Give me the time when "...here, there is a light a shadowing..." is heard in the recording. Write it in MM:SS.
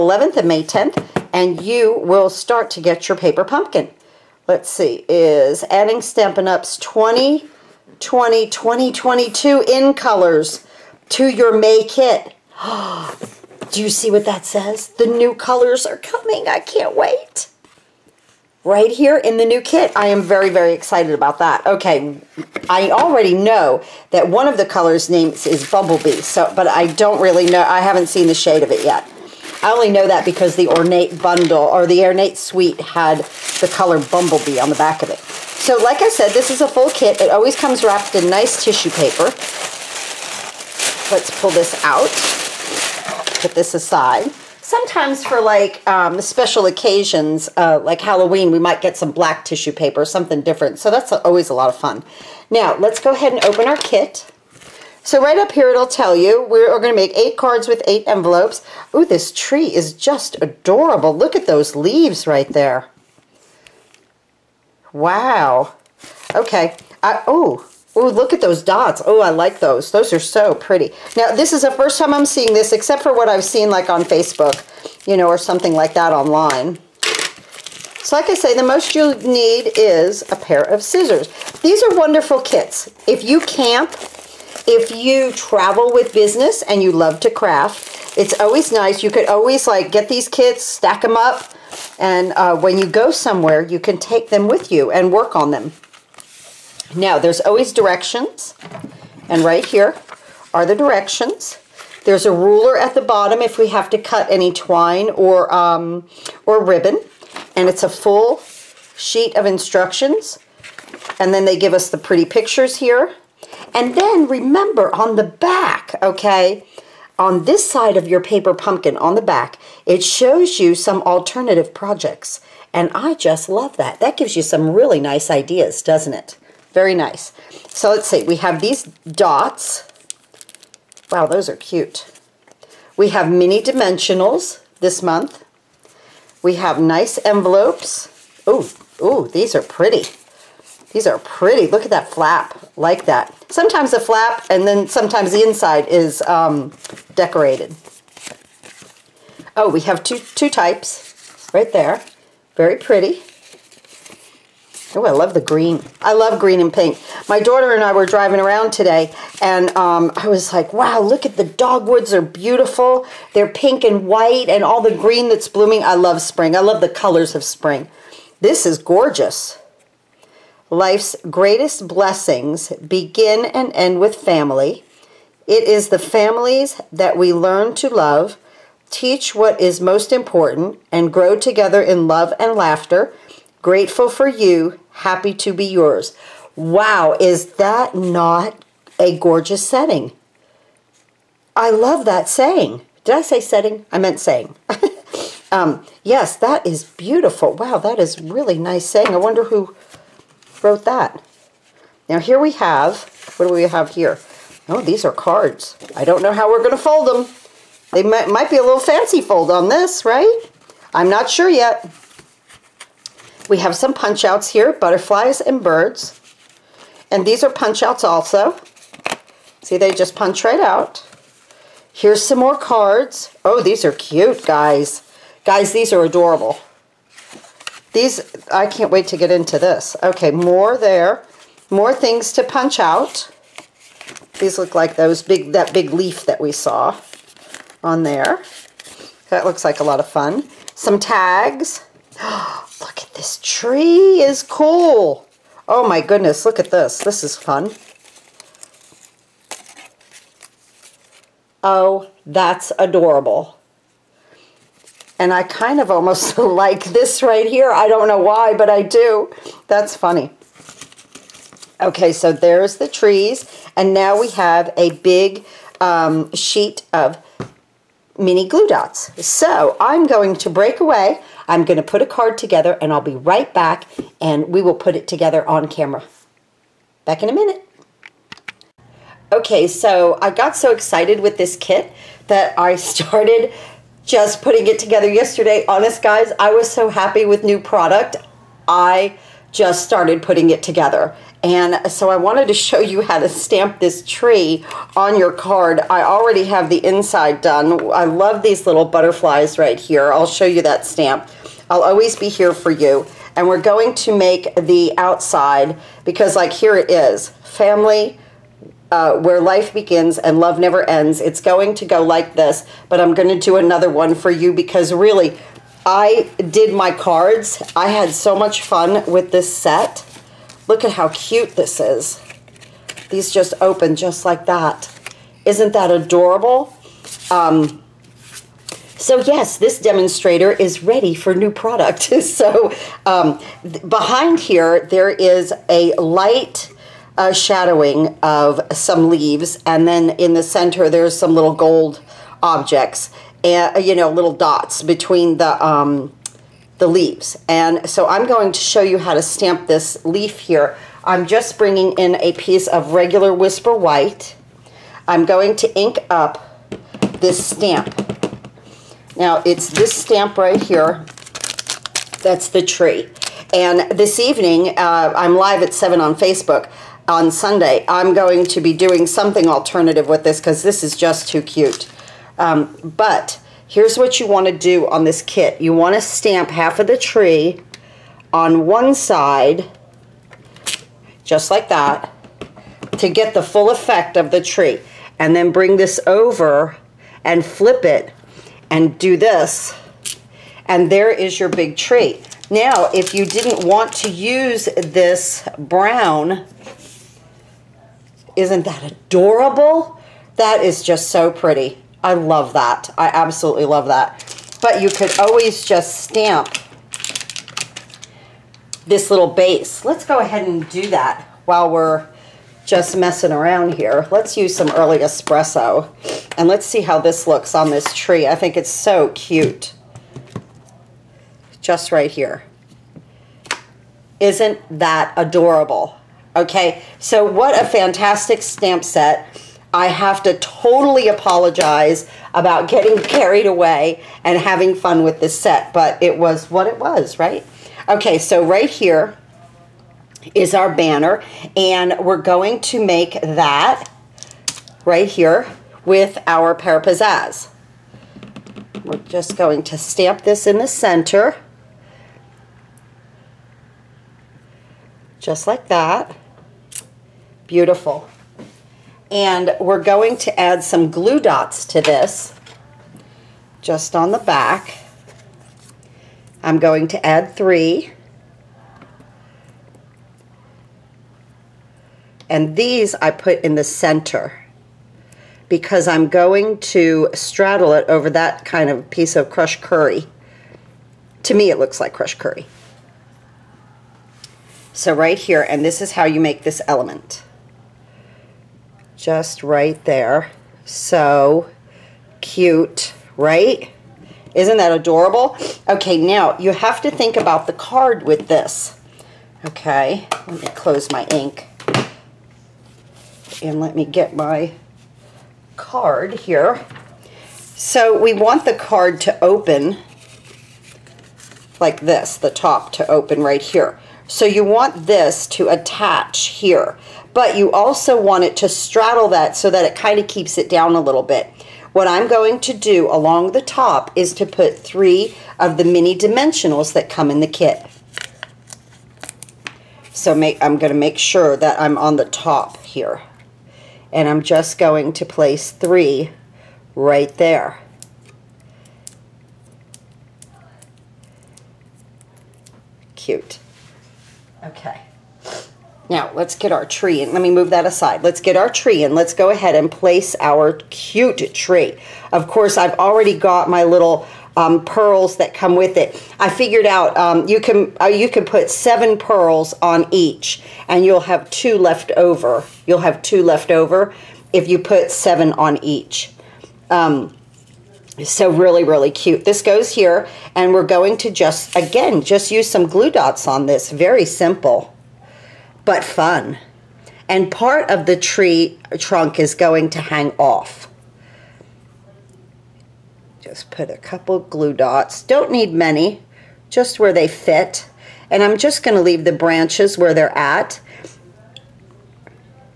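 05:34.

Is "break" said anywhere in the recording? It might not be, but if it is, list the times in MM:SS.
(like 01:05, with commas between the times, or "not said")
04:30.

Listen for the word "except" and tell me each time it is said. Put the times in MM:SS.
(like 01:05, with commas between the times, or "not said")
01:12.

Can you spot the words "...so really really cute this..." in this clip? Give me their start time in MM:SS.
09:28.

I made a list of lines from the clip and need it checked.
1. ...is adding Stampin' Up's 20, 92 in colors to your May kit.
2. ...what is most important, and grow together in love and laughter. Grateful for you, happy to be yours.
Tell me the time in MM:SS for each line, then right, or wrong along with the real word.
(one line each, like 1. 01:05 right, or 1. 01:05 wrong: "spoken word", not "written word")
1. 00:05 wrong: "22", not "92"
2. 02:59 right.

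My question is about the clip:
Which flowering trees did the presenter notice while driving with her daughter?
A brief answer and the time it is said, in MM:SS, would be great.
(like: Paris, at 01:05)
Dogwoods, at 02:41.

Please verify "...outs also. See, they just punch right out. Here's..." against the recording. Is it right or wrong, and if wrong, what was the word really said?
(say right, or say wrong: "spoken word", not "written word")
right.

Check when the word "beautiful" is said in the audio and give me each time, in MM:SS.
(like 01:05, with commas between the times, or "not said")
02:42, 03:16, 07:37.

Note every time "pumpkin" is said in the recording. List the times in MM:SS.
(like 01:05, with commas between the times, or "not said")
00:03, 01:58.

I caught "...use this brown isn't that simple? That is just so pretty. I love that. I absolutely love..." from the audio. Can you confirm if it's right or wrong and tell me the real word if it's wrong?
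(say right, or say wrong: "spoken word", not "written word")
wrong: "adorable", not "simple".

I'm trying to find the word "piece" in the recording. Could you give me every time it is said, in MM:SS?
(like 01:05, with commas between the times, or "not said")
05:52, 07:58.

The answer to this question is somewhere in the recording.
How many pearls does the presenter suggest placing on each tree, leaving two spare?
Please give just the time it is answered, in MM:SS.
09:18.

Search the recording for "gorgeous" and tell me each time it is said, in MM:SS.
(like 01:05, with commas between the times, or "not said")
02:48, 03:09.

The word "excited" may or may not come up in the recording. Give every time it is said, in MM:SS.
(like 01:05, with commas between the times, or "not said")
00:20, 04:40.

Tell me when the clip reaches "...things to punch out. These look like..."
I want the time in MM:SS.
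03:51.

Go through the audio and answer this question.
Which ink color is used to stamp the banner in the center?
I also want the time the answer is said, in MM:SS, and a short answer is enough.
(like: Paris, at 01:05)
Pear Pizzazz, at 07:26.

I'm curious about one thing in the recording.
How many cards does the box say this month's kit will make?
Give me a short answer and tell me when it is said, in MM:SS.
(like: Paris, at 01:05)
8, at 00:57.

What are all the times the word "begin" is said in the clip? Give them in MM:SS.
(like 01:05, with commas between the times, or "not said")
02:52, 05:09.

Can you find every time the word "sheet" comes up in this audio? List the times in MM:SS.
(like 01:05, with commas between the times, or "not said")
01:48, 04:26.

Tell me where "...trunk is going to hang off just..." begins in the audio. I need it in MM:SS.
09:38.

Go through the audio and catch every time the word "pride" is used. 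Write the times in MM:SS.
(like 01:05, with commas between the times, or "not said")
not said.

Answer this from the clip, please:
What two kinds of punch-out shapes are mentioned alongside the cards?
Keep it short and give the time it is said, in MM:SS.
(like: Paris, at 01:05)
Butterflies and birds, at 03:34.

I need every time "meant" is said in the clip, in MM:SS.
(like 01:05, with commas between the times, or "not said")
03:13.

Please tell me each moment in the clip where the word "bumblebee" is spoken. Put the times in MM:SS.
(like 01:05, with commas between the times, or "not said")
00:25, 00:33.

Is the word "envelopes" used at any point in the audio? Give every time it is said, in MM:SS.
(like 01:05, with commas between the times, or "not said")
00:58, 02:17.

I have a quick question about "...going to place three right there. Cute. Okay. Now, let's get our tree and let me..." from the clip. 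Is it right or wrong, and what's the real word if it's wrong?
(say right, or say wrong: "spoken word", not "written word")
right.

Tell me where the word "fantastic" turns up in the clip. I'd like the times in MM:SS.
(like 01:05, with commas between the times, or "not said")
07:07.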